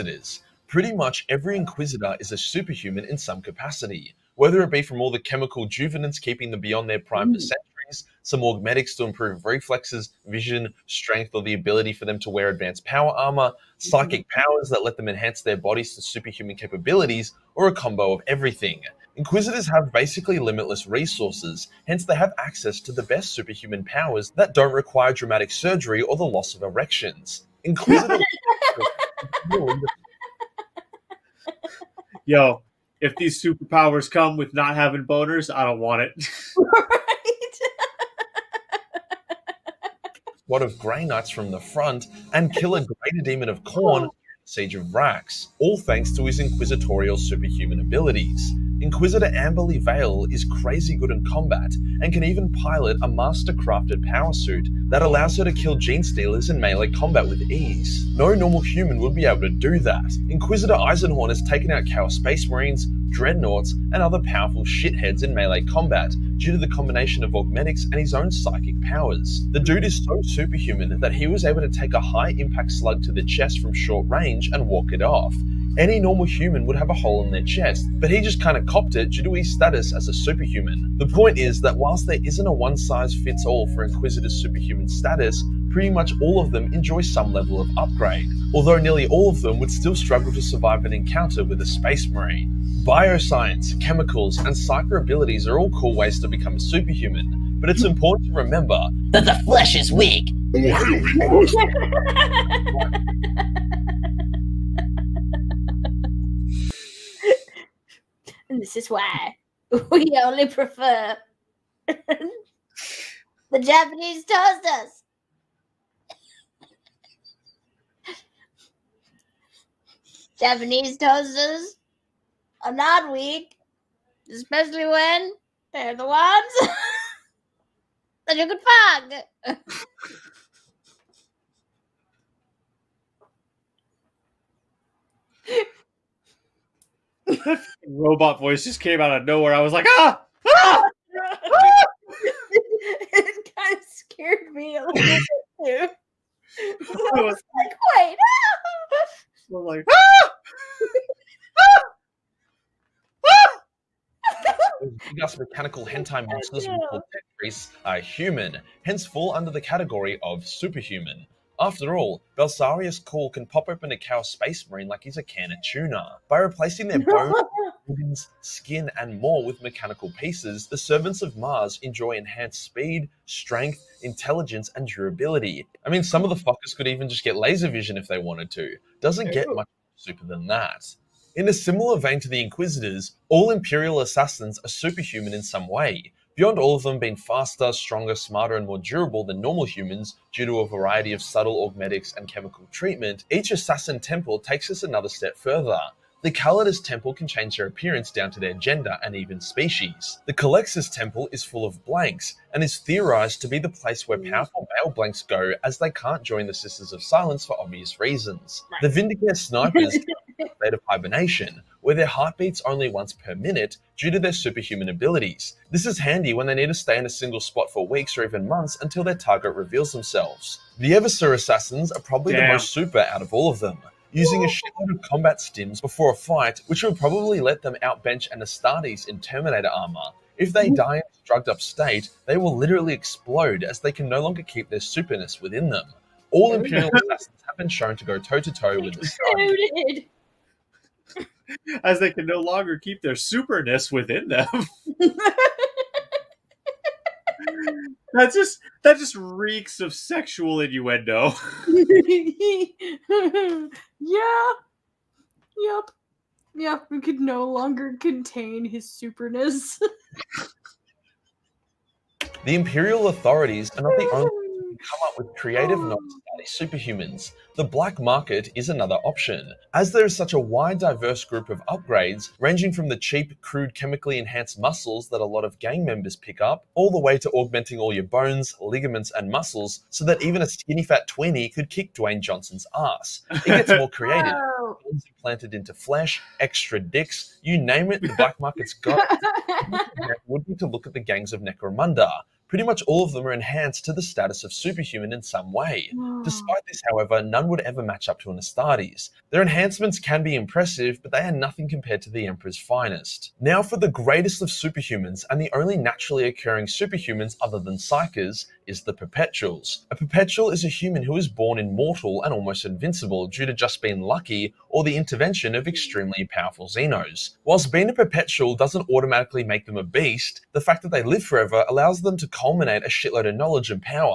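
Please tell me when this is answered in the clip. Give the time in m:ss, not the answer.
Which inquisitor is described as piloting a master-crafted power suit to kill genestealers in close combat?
0:49.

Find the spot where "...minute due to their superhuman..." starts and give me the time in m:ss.
3:33.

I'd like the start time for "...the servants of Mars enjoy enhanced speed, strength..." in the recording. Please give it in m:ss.
2:50.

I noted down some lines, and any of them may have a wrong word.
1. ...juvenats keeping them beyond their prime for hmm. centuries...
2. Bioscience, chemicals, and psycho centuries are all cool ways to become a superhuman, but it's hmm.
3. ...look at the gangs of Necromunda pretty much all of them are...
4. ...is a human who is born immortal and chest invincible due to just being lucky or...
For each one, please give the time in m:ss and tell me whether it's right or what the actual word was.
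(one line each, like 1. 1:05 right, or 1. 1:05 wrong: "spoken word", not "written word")
1. 0:05 right
2. 1:32 wrong: "abilities", not "centuries"
3. 4:50 right
4. 5:10 wrong: "almost", not "chest".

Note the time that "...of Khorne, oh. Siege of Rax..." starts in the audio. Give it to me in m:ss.
0:43.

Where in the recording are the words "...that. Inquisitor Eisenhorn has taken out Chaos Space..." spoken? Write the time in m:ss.
0:59.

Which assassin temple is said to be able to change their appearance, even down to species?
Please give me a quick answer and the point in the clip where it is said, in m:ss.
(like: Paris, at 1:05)
Calidus, at 3:16.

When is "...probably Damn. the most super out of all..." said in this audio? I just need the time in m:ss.
3:42.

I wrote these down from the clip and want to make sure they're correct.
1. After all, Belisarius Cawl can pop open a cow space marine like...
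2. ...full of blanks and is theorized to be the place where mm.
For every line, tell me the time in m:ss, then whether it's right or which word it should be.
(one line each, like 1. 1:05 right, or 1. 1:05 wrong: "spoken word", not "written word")
1. 2:41 right
2. 3:21 right.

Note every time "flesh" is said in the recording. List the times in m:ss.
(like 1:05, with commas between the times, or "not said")
1:39, 4:45.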